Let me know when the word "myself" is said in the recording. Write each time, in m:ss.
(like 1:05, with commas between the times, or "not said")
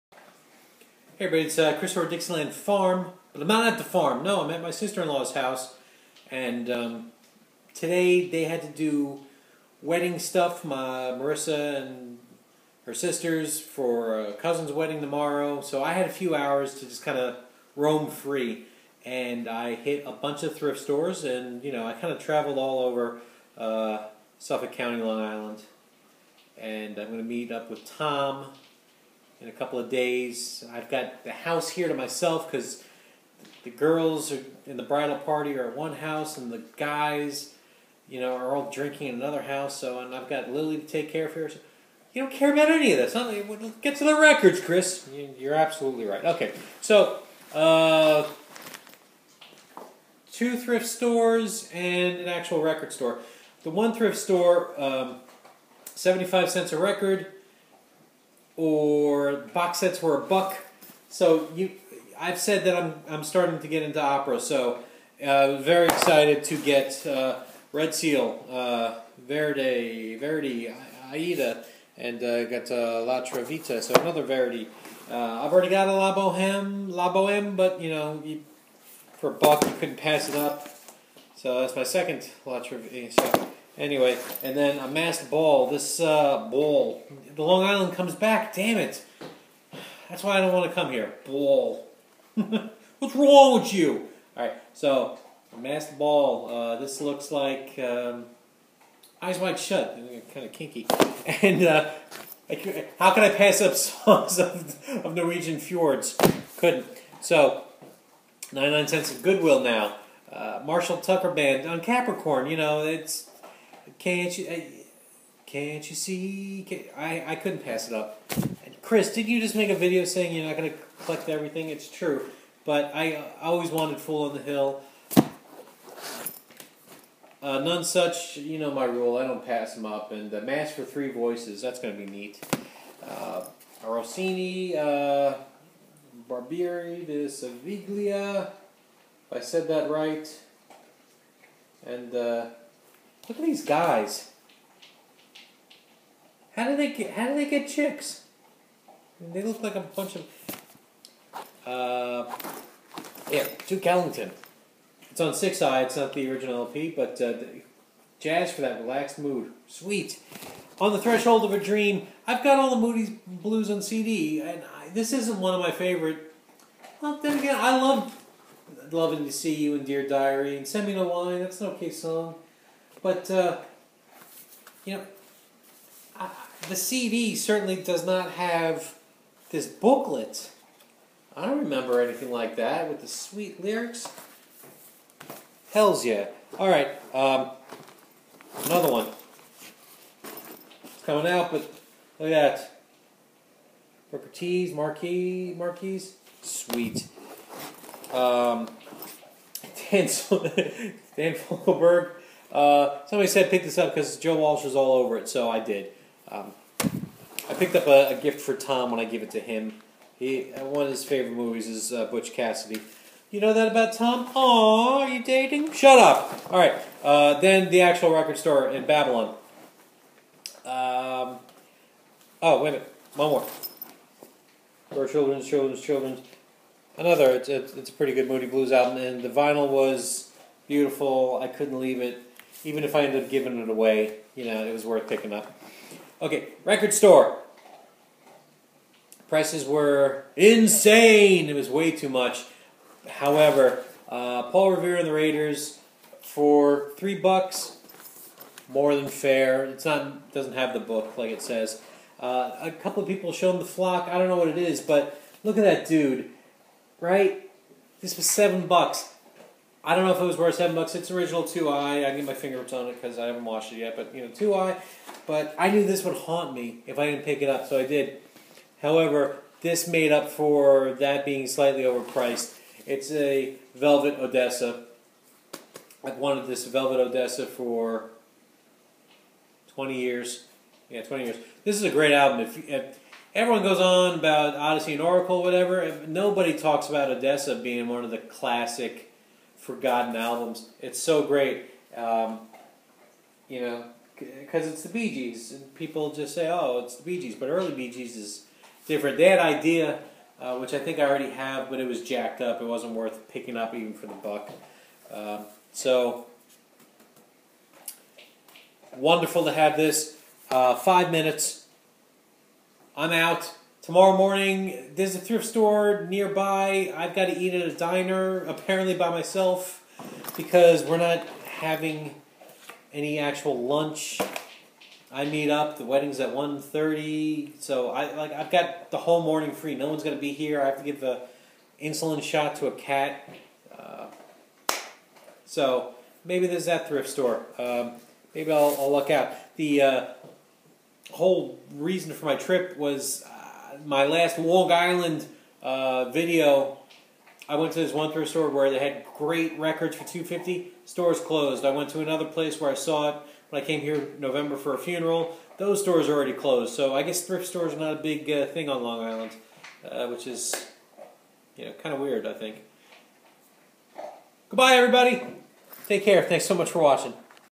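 0:31, 5:19.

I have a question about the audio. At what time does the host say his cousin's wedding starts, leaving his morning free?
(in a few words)
1:30.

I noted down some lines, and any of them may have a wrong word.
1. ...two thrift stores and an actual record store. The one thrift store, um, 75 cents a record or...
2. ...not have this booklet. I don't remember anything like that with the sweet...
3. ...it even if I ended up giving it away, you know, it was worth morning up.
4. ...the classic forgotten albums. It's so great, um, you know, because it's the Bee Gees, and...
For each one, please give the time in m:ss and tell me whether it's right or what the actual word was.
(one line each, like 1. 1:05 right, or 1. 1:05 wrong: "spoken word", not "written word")
1. 0:50 right
2. 2:58 right
3. 3:52 wrong: "picking", not "morning"
4. 4:48 right.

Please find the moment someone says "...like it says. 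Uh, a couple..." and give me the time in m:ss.
4:11.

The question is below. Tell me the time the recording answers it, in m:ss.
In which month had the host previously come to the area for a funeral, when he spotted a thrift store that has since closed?
5:54.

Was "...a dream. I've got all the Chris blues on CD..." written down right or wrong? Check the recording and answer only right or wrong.
wrong.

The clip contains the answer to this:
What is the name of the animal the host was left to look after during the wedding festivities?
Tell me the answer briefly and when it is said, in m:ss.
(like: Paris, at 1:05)
Lily, at 0:40.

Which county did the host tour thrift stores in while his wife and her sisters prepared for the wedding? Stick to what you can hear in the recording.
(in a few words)
Suffolk County.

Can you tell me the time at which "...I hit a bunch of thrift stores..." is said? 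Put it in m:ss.
0:19.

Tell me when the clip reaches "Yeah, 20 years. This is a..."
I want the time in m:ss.
4:40.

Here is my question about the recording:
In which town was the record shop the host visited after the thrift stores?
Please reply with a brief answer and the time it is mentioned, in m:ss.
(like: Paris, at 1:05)
Babylon, at 3:38.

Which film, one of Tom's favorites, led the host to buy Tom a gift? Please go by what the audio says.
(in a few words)
Butch Cassidy.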